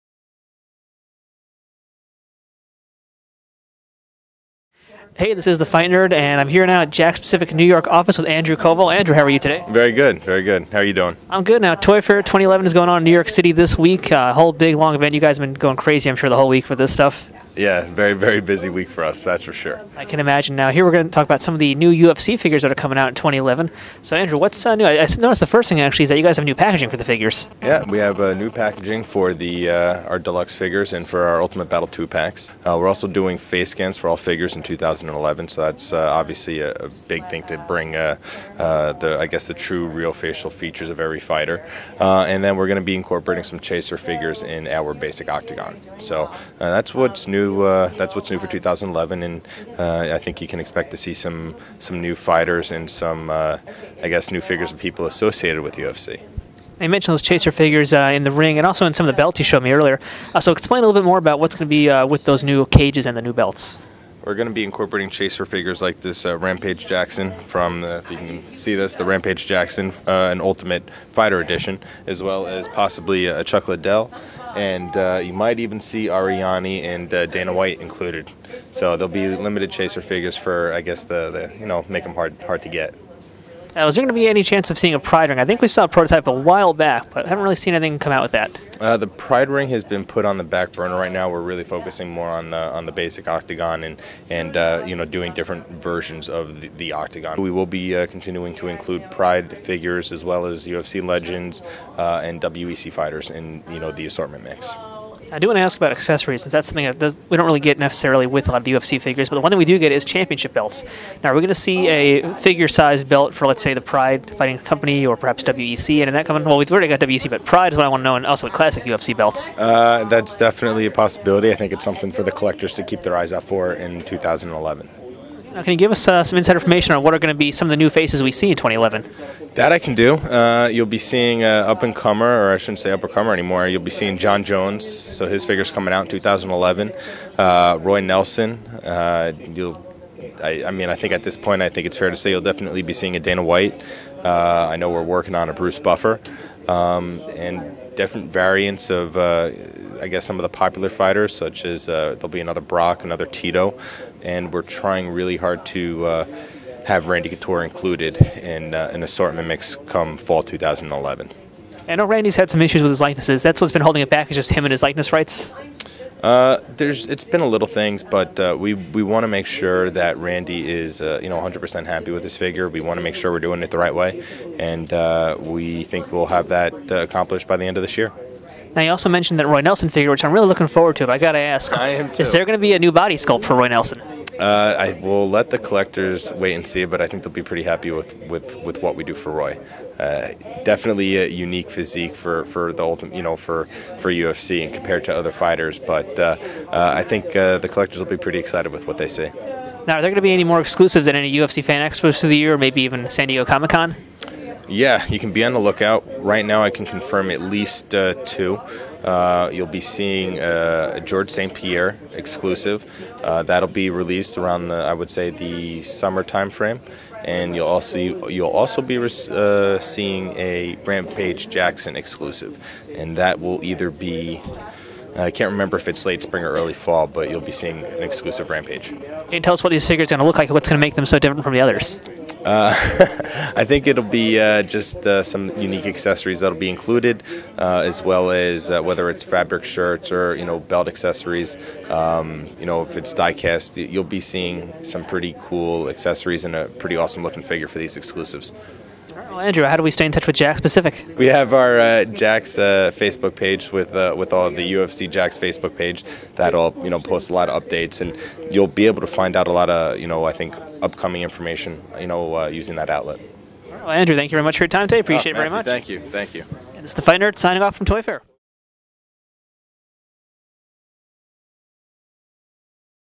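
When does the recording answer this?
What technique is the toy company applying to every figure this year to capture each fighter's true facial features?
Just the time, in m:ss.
0:33.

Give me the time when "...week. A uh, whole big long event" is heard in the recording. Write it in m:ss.
0:13.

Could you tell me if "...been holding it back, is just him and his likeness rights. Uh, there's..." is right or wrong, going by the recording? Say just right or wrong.
right.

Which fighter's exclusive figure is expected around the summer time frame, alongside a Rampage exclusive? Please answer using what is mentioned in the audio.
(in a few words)
George St. Pierre.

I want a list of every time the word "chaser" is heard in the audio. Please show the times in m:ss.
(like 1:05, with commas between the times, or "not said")
0:43, 0:57, 1:05, 1:19.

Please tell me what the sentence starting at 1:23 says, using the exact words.
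Was uh, there going to be any chance of seeing a Pride Ring?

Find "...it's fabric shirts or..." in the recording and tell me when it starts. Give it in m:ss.
3:59.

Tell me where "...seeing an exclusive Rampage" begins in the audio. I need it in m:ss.
3:47.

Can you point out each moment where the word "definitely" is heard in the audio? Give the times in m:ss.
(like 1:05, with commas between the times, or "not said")
2:00, 2:22, 3:10.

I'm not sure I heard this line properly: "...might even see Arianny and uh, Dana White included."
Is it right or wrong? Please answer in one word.
right.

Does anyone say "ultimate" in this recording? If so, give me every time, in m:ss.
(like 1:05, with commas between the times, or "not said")
0:31, 1:10, 3:12.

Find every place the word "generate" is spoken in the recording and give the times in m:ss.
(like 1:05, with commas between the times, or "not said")
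not said.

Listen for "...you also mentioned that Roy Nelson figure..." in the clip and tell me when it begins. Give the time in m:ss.
2:58.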